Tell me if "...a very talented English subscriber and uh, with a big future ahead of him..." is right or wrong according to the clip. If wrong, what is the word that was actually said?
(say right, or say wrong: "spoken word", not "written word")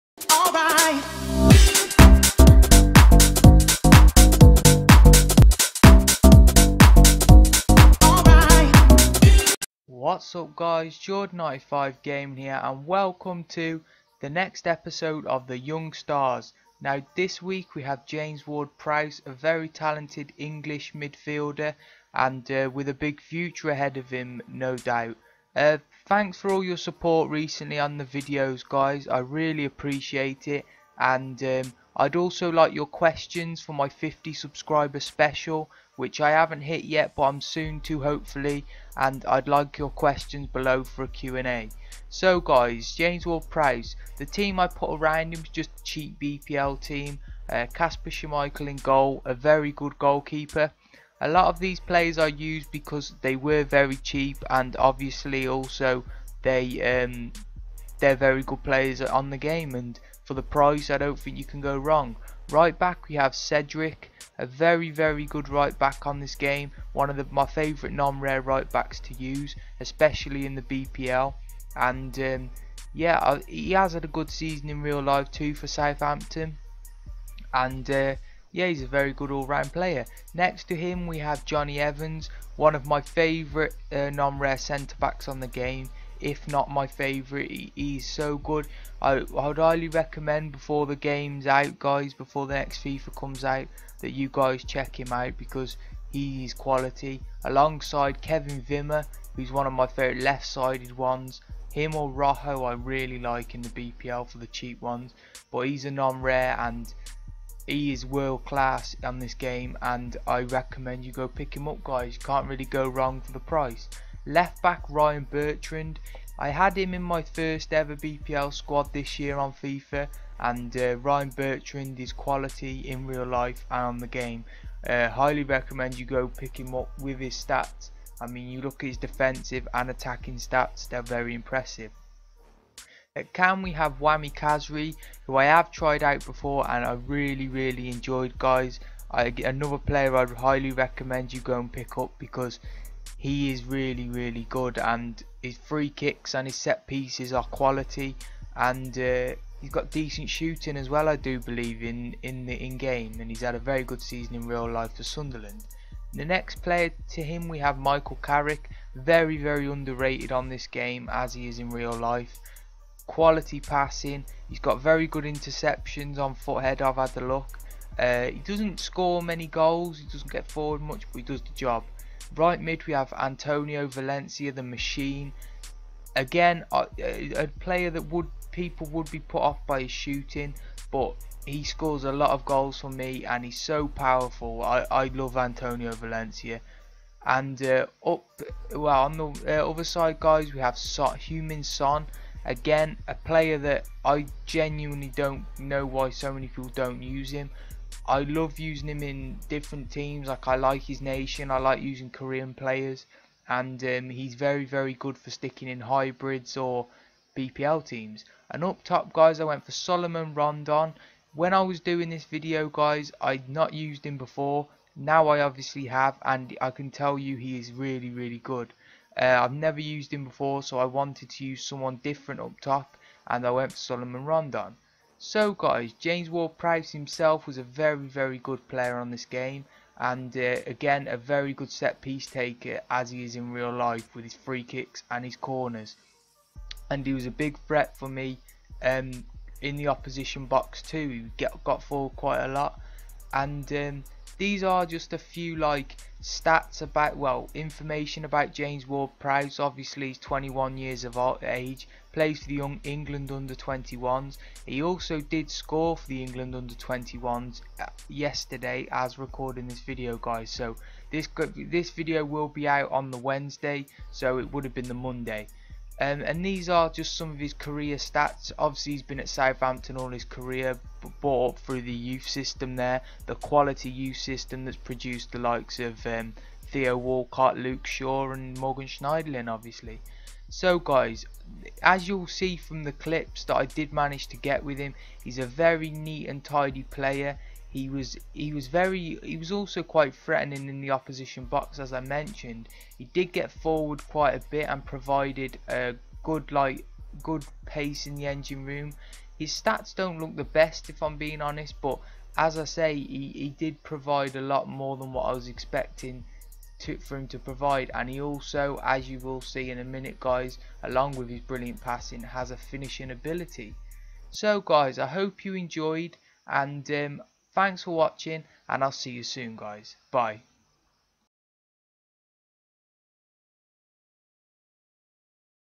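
wrong: "midfielder", not "subscriber".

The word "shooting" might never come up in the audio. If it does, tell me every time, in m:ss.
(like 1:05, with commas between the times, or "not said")
2:30, 2:59.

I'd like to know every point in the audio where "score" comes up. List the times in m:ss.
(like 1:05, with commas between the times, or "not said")
2:48, 3:01, 4:15.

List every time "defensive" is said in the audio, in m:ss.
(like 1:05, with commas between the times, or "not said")
2:08.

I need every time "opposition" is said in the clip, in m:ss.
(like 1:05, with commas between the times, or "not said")
3:59, 4:50.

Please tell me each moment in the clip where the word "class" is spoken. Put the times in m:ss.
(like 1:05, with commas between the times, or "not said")
1:48.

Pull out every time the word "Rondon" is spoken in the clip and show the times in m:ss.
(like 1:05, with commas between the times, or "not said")
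3:30, 3:44.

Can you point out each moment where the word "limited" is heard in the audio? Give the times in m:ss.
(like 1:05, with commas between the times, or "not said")
not said.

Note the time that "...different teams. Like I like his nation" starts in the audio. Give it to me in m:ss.
3:19.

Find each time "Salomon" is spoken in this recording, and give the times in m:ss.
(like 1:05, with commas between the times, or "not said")
3:29, 3:43.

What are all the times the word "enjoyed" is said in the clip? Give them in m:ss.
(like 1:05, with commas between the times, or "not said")
2:17, 5:15.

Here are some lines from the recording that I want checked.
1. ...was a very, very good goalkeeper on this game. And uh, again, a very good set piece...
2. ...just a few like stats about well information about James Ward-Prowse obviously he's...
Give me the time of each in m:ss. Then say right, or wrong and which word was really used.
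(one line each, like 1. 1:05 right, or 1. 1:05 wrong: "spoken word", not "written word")
1. 3:47 wrong: "player", not "goalkeeper"
2. 4:04 right.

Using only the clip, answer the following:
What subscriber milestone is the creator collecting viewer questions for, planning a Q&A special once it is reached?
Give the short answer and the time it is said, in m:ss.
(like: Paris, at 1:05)
50, at 0:33.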